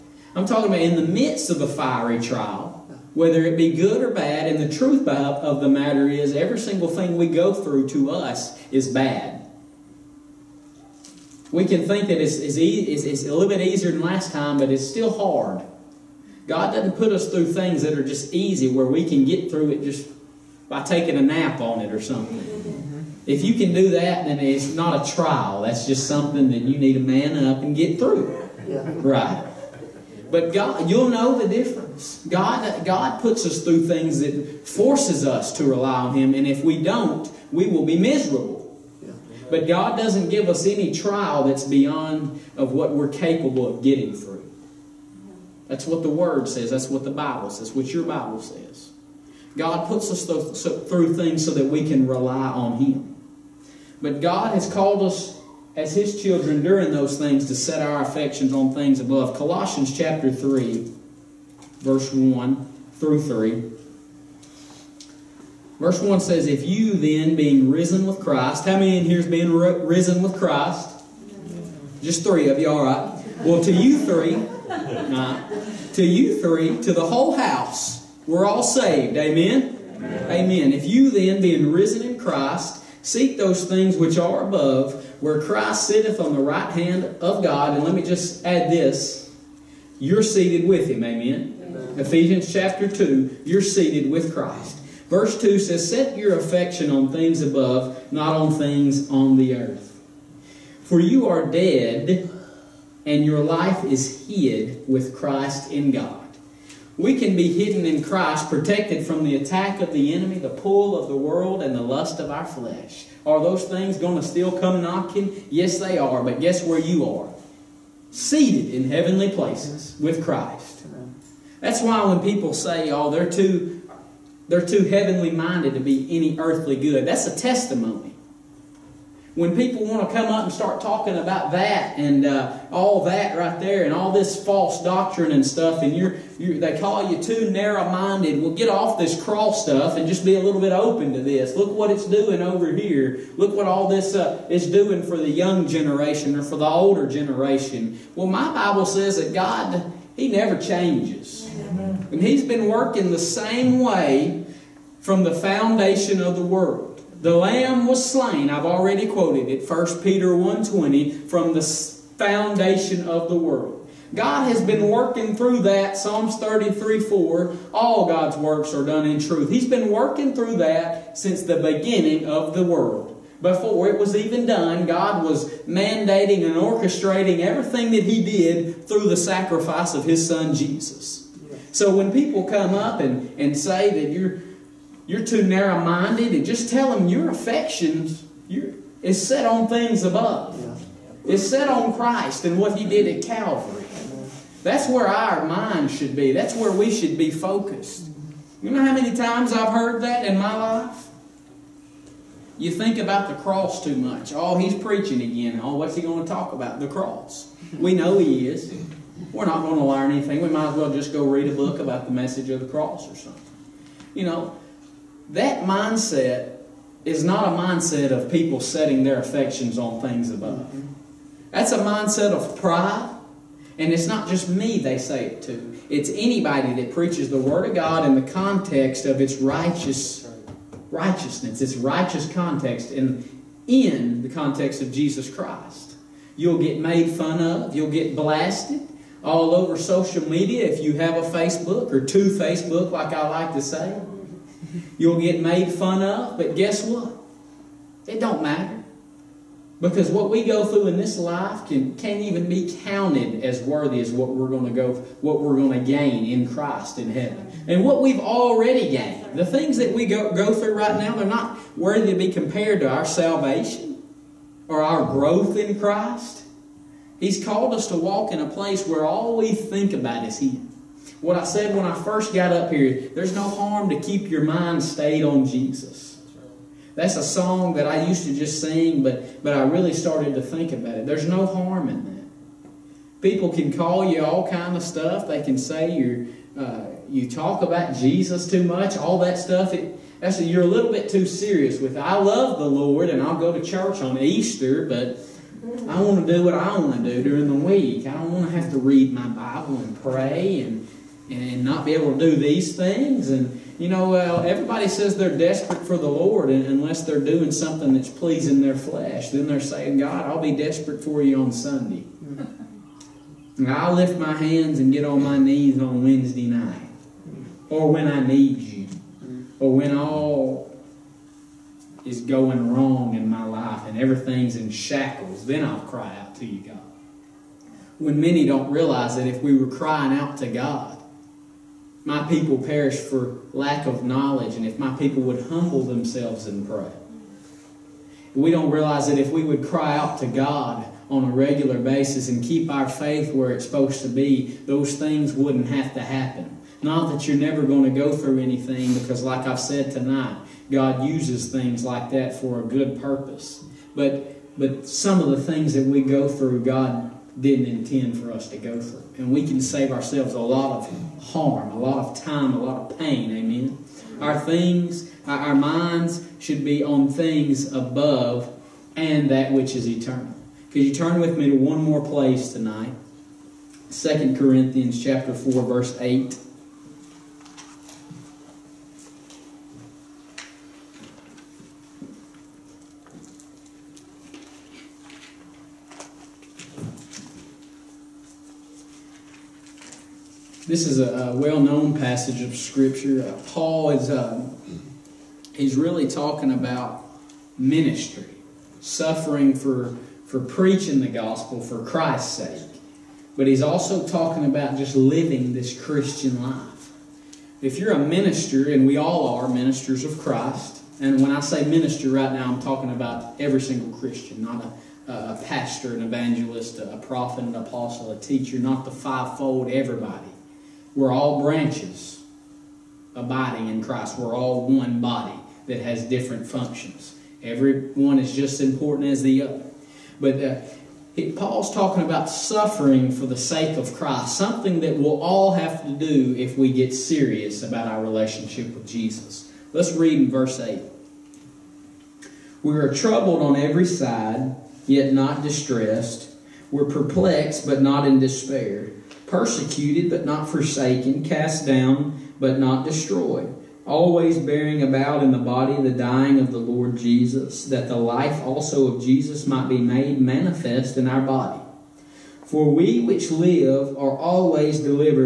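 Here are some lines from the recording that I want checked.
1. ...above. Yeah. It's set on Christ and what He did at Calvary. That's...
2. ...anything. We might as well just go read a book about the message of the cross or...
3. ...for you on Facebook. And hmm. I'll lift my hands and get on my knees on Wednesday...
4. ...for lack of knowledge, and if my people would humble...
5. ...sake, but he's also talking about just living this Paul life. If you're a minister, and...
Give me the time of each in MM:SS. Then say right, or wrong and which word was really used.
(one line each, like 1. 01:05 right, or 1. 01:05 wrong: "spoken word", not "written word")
1. 03:10 right
2. 03:30 right
3. 05:11 wrong: "Sunday", not "Facebook"
4. 05:32 right
5. 06:42 wrong: "Christian", not "Paul".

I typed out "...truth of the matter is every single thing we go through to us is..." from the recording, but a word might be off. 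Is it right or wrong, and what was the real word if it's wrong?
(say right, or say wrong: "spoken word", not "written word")
right.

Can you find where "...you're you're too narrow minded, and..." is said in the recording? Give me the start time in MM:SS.
03:04.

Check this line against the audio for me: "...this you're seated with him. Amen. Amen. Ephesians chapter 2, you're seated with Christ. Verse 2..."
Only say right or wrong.
right.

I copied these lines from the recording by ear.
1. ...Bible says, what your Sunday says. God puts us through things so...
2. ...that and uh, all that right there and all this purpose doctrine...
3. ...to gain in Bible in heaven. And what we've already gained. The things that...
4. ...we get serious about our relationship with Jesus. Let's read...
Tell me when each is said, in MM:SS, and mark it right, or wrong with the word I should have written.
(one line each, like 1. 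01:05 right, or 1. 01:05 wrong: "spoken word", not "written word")
1. 00:47 wrong: "Bible", not "Sunday"
2. 02:11 wrong: "false", not "purpose"
3. 04:15 wrong: "Christ", not "Bible"
4. 07:16 right.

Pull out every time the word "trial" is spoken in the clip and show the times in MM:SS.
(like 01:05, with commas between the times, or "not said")
00:02, 00:25, 00:40.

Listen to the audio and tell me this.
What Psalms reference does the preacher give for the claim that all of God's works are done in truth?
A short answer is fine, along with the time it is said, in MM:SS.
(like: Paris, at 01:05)
Psalms 33:4, at 02:45.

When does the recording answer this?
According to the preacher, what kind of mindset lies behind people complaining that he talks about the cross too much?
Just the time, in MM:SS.
03:41.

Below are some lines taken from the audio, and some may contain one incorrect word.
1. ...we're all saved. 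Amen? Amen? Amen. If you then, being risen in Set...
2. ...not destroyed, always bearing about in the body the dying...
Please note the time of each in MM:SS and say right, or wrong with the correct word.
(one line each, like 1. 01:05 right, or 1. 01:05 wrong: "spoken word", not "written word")
1. 01:18 wrong: "Christ", not "Set"
2. 07:32 right.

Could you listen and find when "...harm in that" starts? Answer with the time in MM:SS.
04:41.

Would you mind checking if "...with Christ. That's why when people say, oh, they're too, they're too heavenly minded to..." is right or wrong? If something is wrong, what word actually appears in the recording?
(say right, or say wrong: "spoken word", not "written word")
right.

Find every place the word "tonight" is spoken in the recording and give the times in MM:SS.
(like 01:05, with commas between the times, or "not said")
05:49, 06:12.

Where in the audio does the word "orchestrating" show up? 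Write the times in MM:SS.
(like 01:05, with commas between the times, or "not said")
02:56.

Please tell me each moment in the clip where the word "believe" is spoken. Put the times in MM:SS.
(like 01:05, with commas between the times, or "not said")
not said.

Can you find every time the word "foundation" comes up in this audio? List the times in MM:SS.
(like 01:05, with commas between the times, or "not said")
02:35, 02:41.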